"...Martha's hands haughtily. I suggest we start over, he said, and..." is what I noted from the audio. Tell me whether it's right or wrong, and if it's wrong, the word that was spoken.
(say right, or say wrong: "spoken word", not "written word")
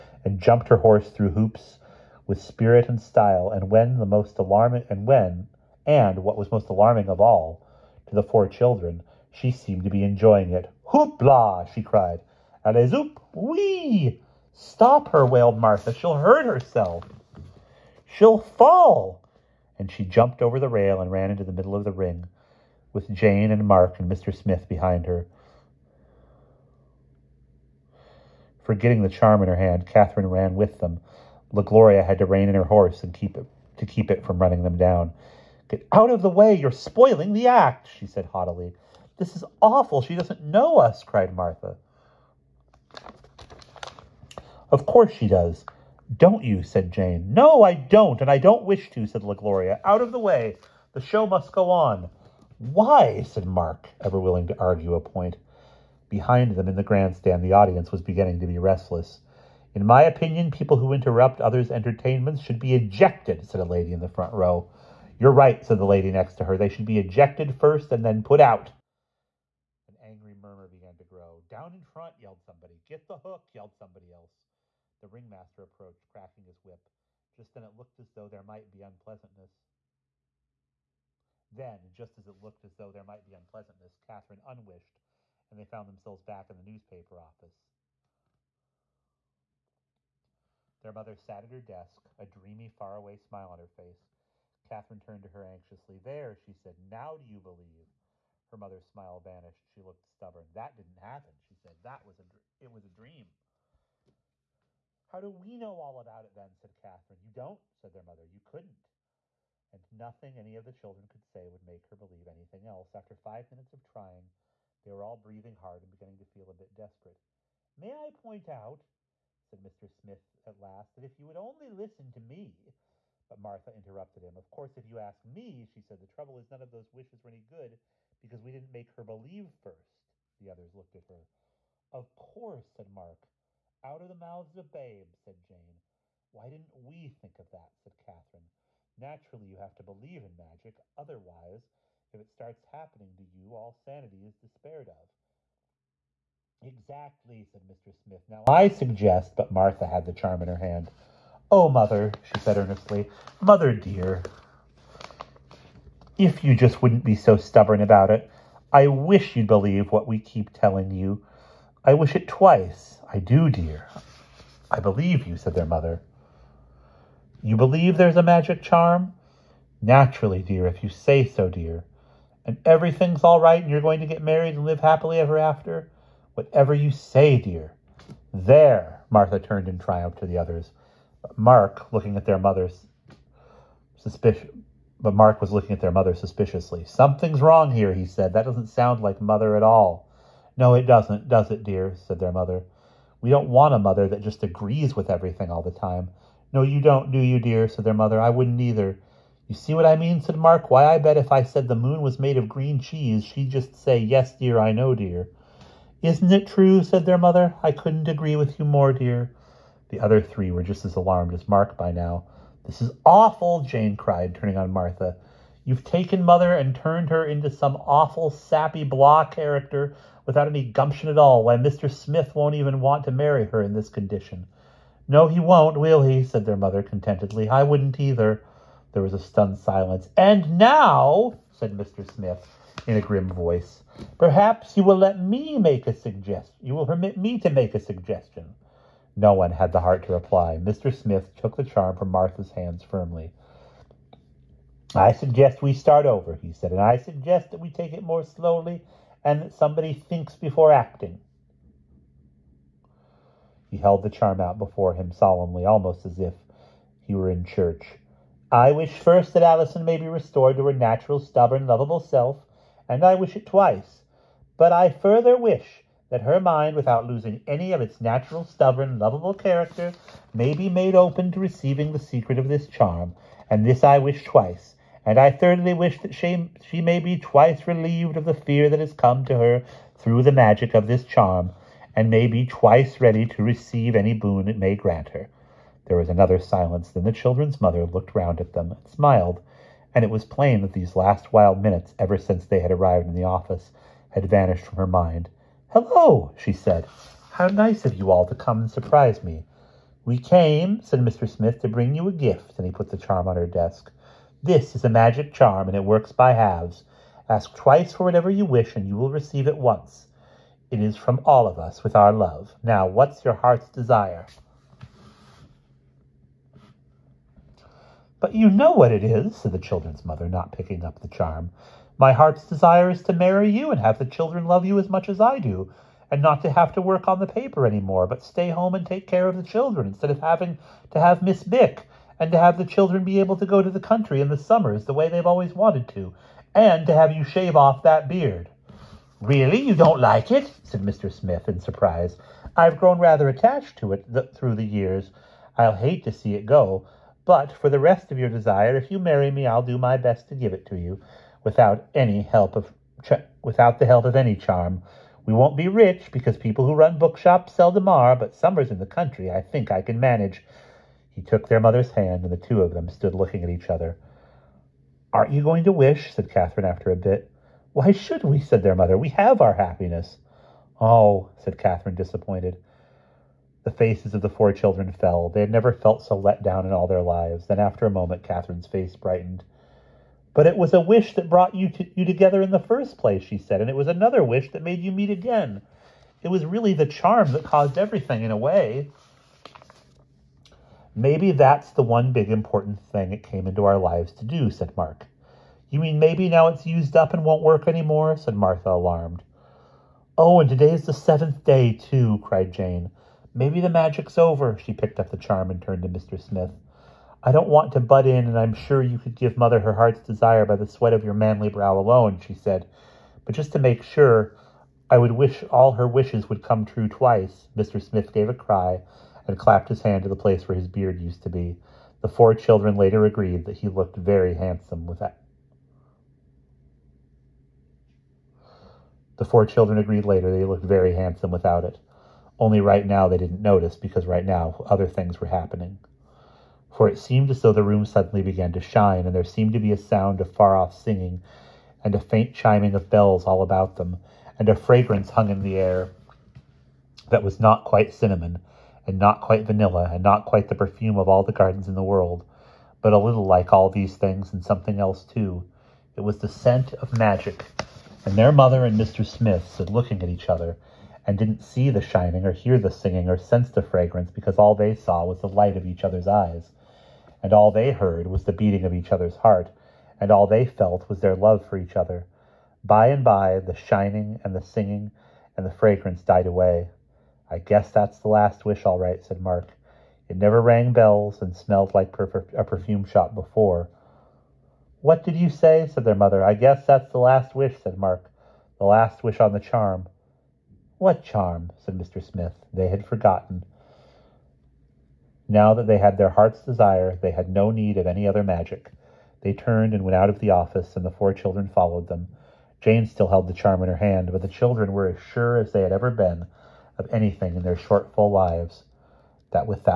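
wrong: "firmly", not "haughtily".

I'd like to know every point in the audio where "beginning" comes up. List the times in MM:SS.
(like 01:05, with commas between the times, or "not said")
00:58, 01:55.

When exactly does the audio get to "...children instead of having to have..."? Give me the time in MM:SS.
05:29.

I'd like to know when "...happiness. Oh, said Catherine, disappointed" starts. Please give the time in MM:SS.
06:09.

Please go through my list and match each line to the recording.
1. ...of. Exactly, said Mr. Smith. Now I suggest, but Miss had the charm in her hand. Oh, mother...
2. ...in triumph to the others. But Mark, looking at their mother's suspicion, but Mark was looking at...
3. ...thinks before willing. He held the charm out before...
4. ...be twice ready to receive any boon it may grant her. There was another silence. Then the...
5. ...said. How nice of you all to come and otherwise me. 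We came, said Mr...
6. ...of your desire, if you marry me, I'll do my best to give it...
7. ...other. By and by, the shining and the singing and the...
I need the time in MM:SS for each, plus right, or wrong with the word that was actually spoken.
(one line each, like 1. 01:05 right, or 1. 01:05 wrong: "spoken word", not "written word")
1. 02:24 wrong: "Martha", not "Miss"
2. 02:59 right
3. 04:09 wrong: "acting", not "willing"
4. 04:42 right
5. 04:56 wrong: "surprise", not "otherwise"
6. 05:48 right
7. 07:51 right.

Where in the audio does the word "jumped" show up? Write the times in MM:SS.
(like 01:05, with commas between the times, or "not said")
00:00, 00:20.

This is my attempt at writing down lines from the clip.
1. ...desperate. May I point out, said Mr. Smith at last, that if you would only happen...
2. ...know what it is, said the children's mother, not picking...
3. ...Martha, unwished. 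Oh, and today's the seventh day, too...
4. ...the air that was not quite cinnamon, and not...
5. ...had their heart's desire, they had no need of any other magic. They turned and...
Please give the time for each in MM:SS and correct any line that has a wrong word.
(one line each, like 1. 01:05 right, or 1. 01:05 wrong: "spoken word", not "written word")
1. 01:56 wrong: "listen", not "happen"
2. 05:18 right
3. 06:38 wrong: "alarmed", not "unwished"
4. 07:25 right
5. 08:15 right.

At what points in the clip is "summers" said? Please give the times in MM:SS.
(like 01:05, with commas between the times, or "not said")
05:34, 05:58.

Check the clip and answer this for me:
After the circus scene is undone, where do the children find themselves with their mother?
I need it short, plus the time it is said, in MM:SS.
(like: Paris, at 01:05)
the newspaper office, at 01:26.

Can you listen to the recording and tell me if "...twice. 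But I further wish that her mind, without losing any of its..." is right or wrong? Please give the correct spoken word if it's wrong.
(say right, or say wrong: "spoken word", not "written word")
right.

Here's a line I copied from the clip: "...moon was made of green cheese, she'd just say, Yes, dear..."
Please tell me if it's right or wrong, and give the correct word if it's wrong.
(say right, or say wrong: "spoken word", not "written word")
right.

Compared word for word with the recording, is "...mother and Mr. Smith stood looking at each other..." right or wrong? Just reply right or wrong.
right.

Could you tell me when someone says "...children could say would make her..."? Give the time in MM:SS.
01:50.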